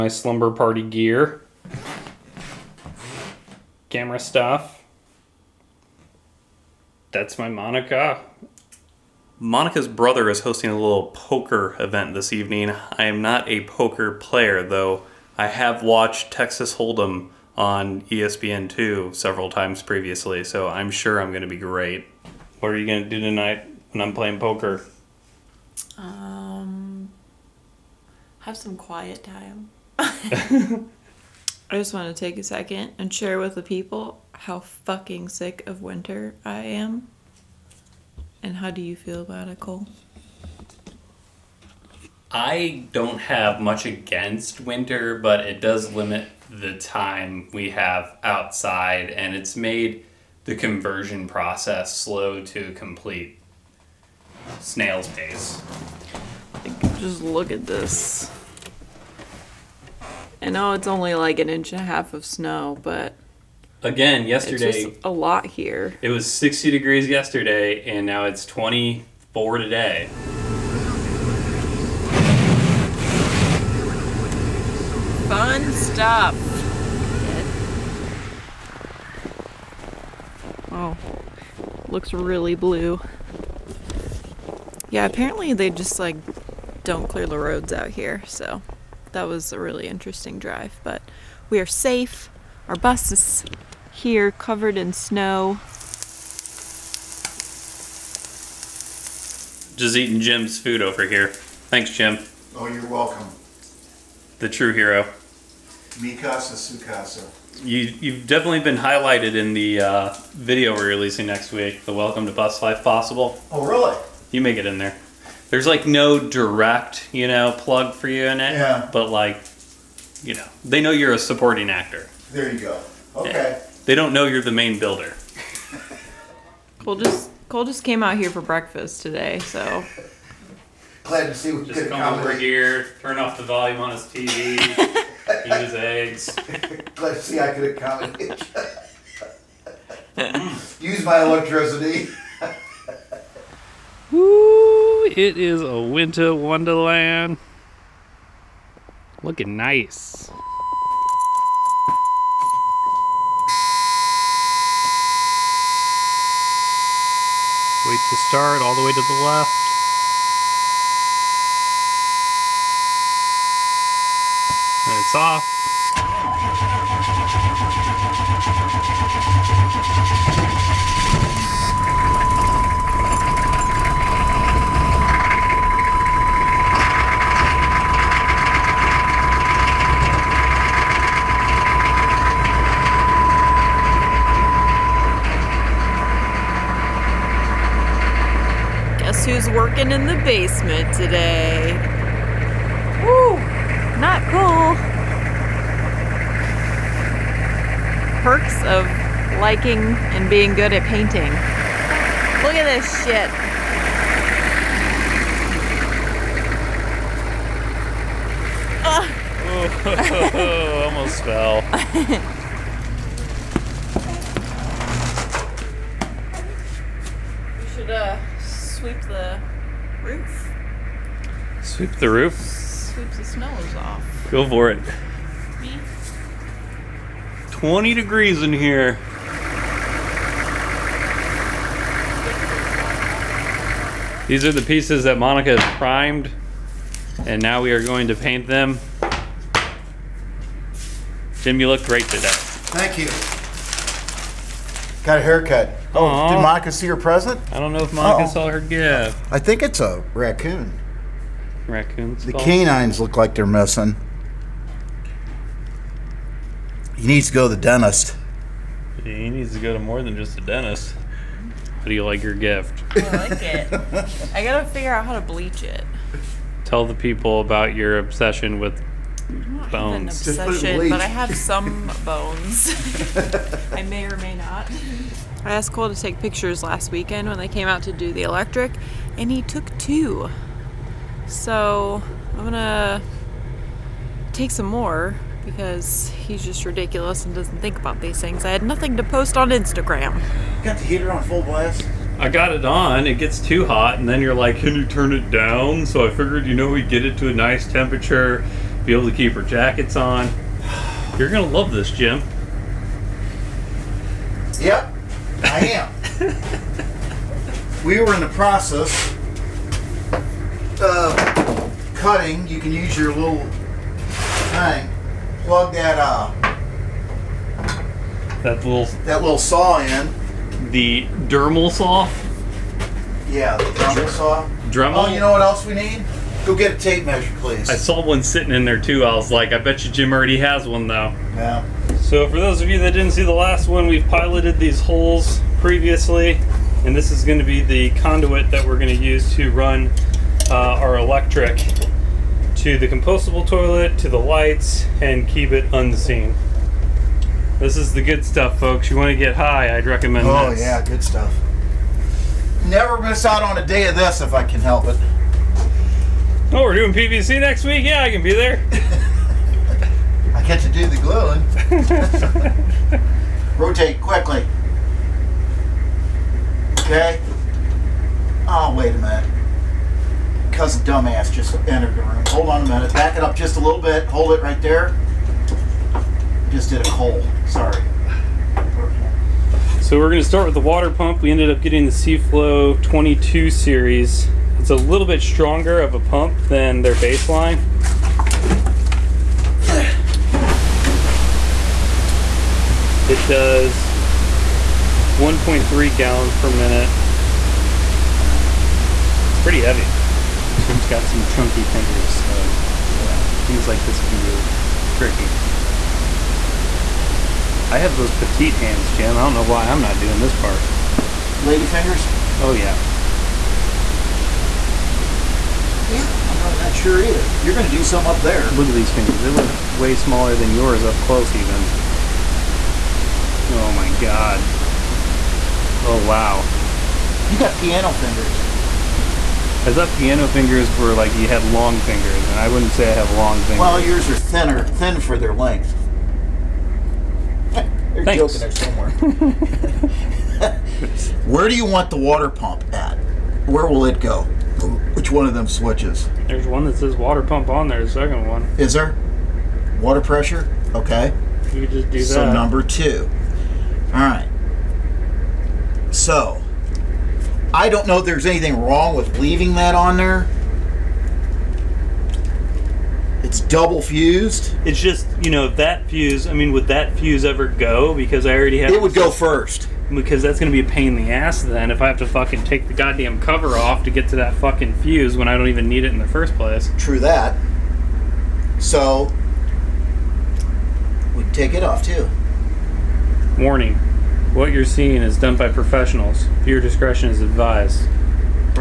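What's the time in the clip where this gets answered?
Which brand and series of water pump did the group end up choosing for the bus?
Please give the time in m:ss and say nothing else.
6:21.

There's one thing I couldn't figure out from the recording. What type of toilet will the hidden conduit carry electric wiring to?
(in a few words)
compostable toilet.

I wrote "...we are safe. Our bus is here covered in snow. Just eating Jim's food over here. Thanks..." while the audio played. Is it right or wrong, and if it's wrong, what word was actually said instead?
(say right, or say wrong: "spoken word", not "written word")
right.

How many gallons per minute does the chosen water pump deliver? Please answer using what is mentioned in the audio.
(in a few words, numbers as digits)
1.3.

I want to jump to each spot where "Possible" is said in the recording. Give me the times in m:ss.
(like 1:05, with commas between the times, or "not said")
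1:52.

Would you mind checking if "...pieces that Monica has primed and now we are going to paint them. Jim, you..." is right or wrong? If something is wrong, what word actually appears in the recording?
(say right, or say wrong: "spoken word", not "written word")
right.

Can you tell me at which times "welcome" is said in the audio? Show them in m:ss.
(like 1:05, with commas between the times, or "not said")
1:42, 1:51.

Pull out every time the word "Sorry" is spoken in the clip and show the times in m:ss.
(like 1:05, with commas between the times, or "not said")
6:17.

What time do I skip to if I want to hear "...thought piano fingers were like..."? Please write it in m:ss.
7:09.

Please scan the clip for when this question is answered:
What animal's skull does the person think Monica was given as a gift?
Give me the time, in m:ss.
4:10.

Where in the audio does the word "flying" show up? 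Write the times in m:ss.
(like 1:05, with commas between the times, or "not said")
not said.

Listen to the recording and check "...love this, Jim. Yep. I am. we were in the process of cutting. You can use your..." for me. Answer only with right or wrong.
right.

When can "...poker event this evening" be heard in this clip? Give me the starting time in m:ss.
0:11.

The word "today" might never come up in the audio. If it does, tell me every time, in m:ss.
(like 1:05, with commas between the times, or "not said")
1:09, 2:09, 3:10, 4:02.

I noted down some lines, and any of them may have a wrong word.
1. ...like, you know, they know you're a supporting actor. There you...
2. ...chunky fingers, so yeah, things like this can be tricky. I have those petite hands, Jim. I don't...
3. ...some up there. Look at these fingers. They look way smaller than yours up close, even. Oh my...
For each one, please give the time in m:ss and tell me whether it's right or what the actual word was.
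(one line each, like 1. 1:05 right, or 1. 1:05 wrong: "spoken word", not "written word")
1. 1:59 right
2. 6:41 right
3. 6:57 right.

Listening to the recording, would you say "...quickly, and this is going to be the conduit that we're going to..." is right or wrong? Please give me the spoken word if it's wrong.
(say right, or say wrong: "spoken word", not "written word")
wrong: "previously", not "quickly".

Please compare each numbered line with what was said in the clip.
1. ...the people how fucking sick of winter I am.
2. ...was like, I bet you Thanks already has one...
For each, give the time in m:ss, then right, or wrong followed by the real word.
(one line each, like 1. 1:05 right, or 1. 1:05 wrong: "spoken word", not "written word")
1. 0:33 right
2. 5:29 wrong: "Jim", not "Thanks".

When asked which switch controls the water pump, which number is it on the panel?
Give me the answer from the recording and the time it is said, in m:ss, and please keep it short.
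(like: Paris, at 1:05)
2, at 7:32.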